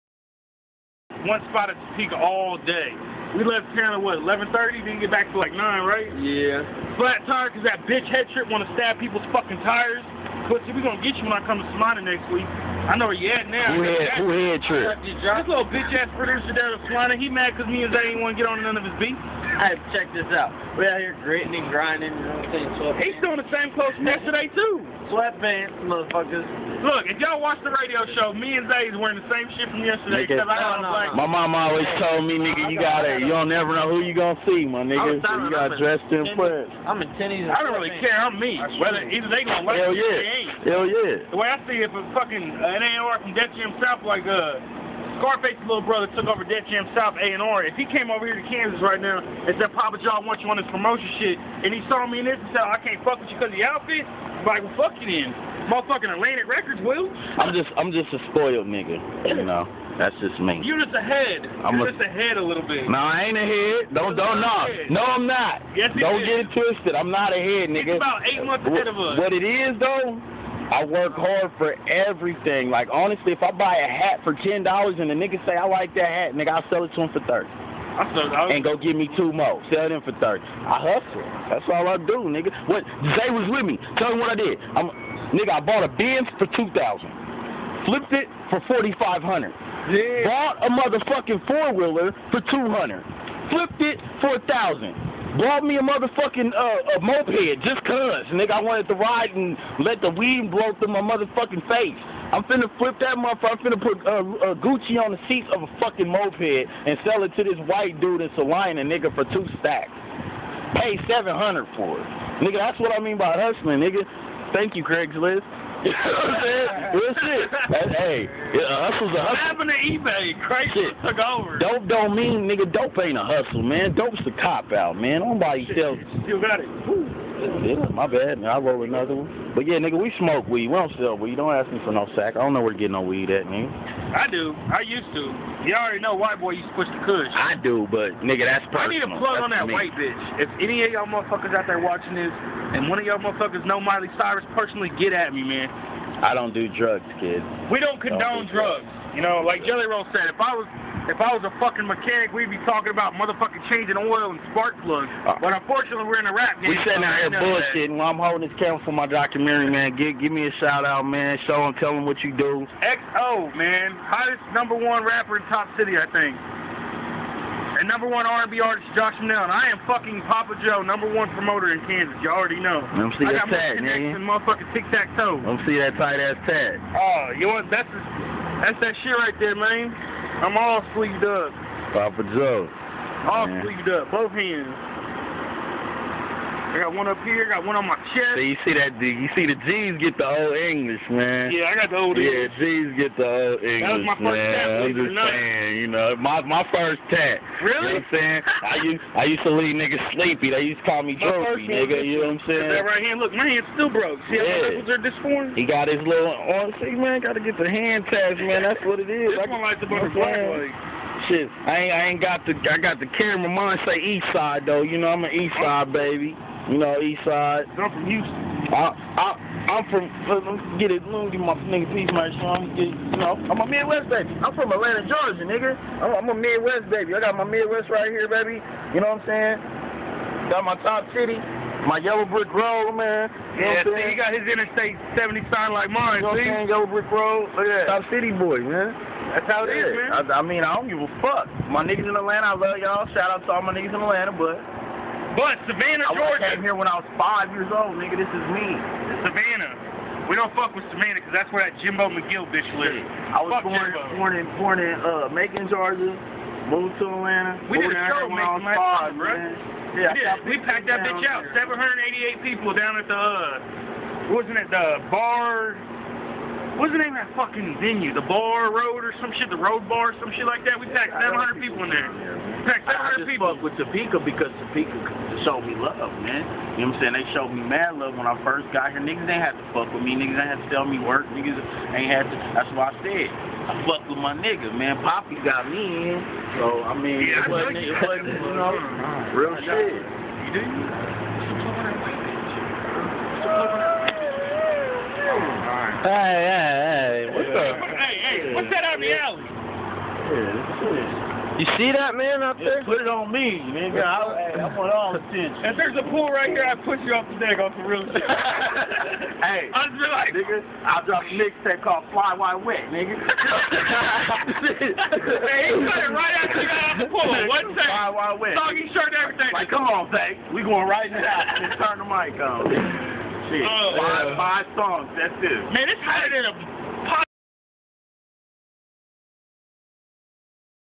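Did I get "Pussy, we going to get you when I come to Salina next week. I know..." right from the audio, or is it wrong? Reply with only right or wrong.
right.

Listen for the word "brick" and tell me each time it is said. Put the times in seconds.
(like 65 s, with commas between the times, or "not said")
232 s, 236 s.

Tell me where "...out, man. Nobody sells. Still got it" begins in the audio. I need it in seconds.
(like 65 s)
124 s.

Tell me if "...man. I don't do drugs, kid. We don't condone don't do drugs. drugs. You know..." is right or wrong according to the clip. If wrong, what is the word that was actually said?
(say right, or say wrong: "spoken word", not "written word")
right.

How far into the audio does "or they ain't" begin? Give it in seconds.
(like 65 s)
40 s.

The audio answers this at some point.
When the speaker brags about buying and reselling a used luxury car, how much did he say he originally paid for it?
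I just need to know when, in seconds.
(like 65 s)
86 s.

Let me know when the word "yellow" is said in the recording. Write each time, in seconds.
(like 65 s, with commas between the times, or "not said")
231 s, 236 s.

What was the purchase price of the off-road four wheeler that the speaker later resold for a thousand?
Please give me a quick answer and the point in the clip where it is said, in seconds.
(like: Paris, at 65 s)
$200, at 92 s.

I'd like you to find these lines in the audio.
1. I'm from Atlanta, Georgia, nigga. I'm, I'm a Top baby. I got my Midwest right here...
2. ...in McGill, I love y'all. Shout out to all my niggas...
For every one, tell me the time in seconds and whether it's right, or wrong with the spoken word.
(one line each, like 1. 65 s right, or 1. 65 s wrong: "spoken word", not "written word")
1. 224 s wrong: "Midwest", not "Top"
2. 242 s wrong: "Atlanta", not "McGill".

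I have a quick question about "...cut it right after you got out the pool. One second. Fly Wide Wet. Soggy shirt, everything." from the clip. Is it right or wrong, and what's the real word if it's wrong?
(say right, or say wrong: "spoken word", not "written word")
right.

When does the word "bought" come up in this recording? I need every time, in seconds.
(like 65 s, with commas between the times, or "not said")
85 s, 90 s, 95 s.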